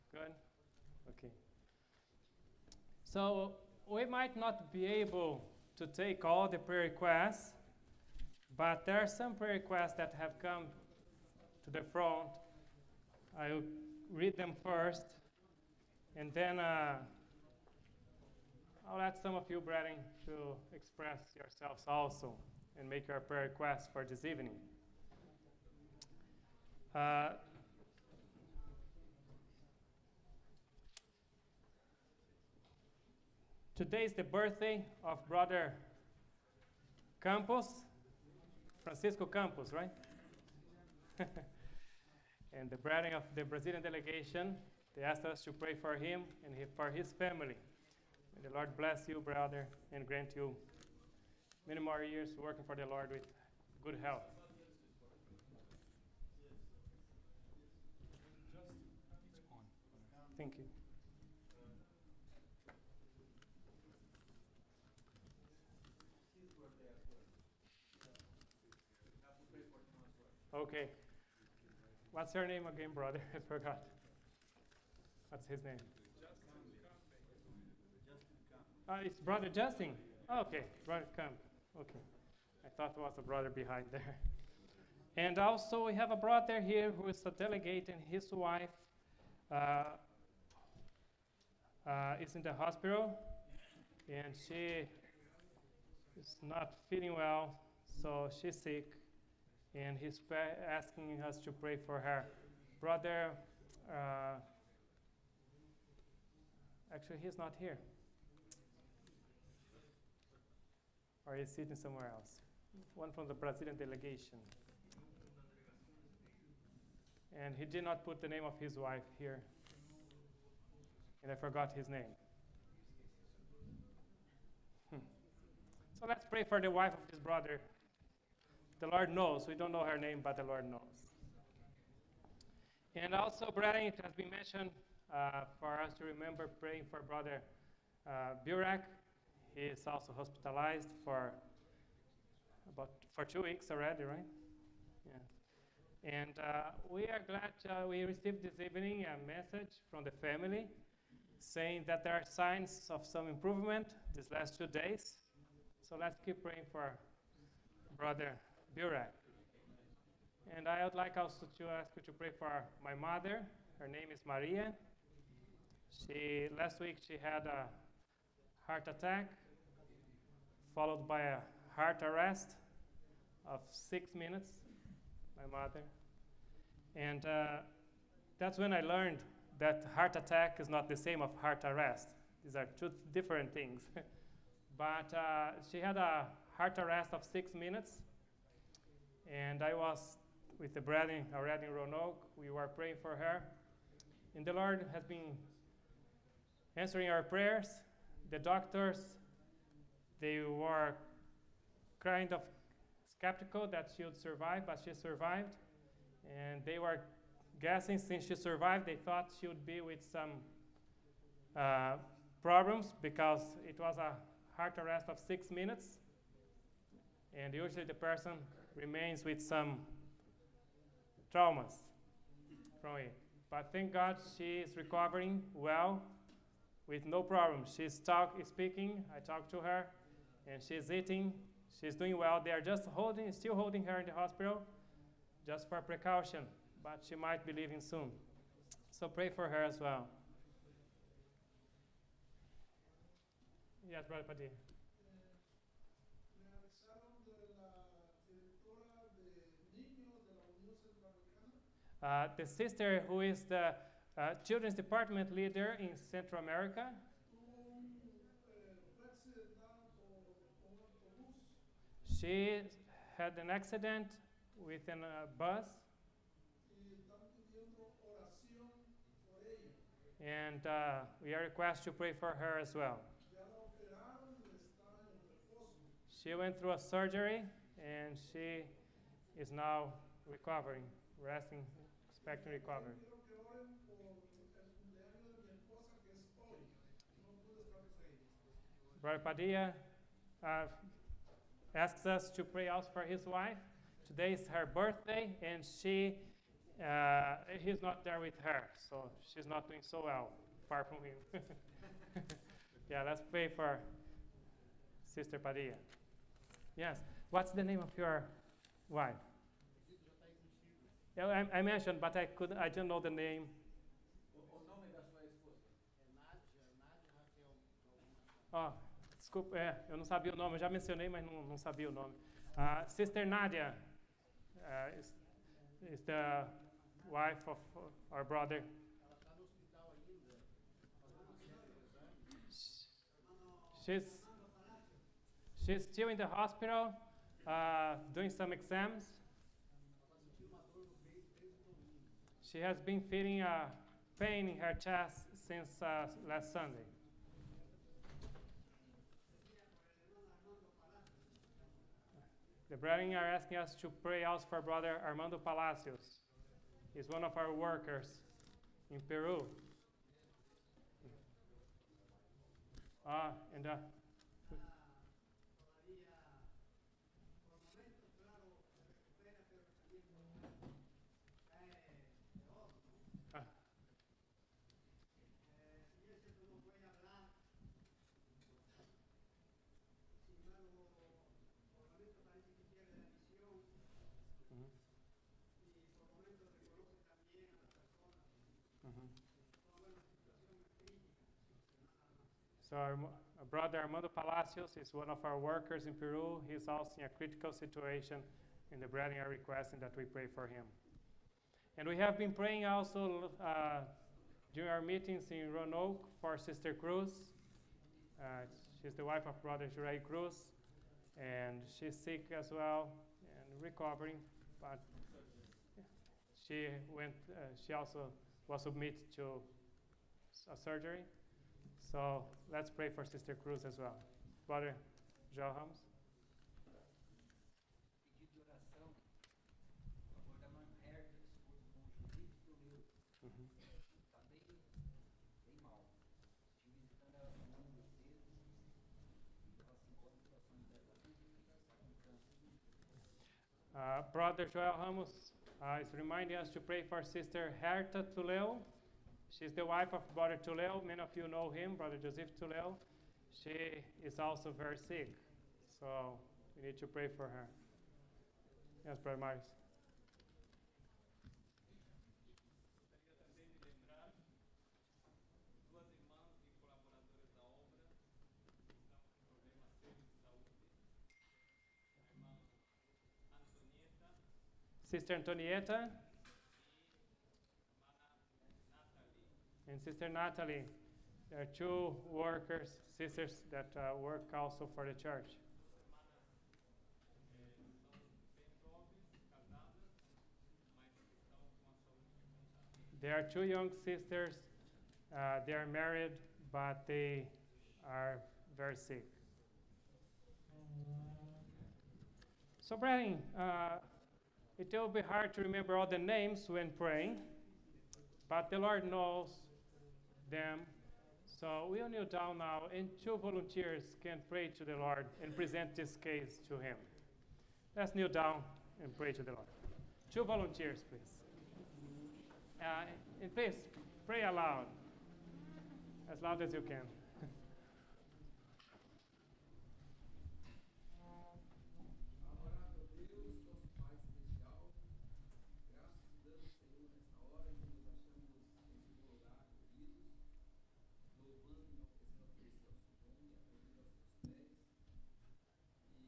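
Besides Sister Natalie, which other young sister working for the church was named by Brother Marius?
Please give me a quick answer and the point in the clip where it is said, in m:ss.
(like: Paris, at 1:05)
Antonieta, at 7:55.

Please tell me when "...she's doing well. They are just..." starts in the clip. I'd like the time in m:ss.
3:51.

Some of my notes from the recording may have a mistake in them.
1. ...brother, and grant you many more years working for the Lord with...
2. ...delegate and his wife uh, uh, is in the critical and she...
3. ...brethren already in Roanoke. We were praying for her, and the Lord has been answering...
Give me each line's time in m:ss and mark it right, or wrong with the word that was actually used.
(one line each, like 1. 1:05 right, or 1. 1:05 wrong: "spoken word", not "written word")
1. 0:49 right
2. 1:27 wrong: "hospital", not "critical"
3. 3:10 right.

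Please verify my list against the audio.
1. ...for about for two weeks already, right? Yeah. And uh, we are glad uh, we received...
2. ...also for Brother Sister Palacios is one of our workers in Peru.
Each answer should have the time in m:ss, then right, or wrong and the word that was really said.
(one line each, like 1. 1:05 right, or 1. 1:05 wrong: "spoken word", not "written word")
1. 2:21 right
2. 5:54 wrong: "Armando", not "Sister".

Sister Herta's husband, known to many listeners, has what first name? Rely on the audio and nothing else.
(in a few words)
Joseph.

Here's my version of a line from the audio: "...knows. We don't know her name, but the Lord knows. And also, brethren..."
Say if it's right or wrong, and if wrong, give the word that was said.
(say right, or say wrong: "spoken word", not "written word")
right.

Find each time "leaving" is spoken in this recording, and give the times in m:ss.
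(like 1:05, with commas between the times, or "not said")
3:57.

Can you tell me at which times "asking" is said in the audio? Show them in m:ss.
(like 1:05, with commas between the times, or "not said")
1:40, 5:53.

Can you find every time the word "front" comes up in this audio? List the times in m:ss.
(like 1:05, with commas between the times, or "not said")
0:11.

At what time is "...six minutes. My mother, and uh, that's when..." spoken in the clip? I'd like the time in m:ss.
2:53.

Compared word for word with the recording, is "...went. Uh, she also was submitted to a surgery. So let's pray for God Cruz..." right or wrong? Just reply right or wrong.
wrong.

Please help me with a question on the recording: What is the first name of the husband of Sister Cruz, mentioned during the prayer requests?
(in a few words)
Jurei.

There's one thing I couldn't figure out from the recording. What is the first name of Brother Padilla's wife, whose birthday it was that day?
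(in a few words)
Nadia.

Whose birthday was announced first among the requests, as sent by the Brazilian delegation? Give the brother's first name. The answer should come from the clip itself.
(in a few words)
Francisco.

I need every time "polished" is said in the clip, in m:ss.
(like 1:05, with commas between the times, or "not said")
not said.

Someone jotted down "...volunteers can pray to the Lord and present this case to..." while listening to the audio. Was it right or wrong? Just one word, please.
right.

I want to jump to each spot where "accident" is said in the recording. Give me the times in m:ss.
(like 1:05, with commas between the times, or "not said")
4:23.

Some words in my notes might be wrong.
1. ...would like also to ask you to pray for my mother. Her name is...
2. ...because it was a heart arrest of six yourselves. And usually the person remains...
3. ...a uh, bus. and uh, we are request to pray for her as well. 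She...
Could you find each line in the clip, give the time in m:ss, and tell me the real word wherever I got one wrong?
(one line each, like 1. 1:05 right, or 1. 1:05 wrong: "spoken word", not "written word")
1. 2:40 right
2. 3:33 wrong: "minutes", not "yourselves"
3. 4:24 right.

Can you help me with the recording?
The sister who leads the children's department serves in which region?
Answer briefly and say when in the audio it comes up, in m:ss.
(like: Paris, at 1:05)
Central America, at 4:16.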